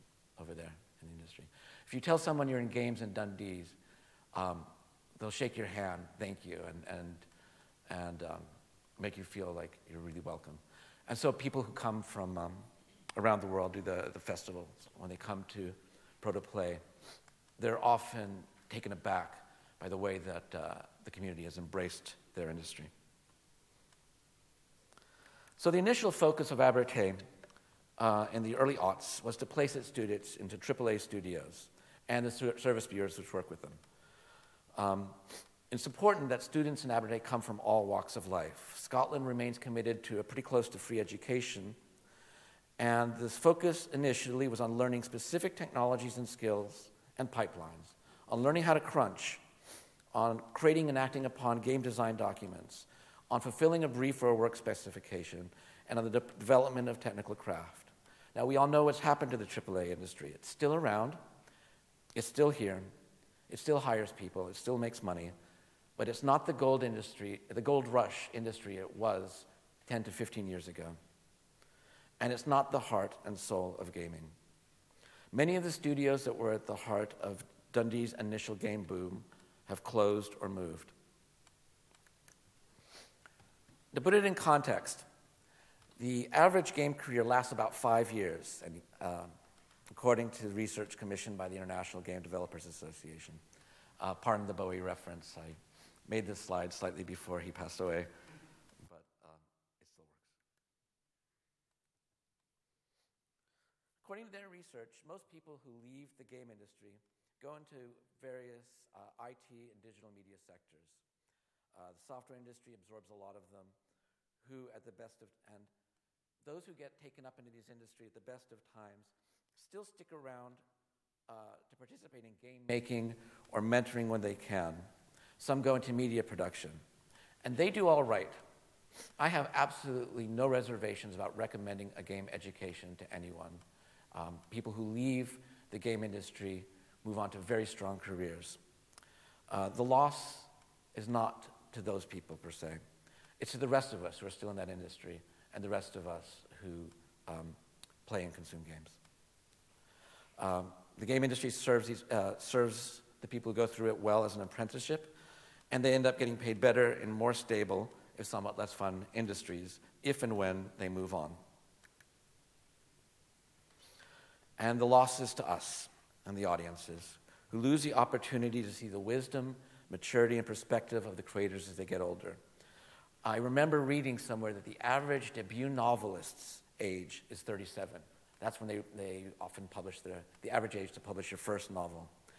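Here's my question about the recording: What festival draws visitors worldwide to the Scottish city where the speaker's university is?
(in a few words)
Protoplay.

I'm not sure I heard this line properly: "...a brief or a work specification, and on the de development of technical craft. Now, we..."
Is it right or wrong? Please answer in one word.
right.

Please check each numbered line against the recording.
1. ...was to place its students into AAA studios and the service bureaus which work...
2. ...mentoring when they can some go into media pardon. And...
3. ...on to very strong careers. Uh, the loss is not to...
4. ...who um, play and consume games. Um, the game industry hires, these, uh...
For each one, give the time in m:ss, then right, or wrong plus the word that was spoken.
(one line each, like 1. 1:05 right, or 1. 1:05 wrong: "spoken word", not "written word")
1. 0:29 right
2. 2:03 wrong: "production", not "pardon"
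3. 2:17 right
4. 2:26 wrong: "serves", not "hires".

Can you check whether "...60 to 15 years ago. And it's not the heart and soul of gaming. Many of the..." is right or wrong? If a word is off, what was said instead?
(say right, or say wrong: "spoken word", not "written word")
wrong: "10", not "60".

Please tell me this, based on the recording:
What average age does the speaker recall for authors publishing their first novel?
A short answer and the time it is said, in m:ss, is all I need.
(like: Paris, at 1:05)
37, at 2:57.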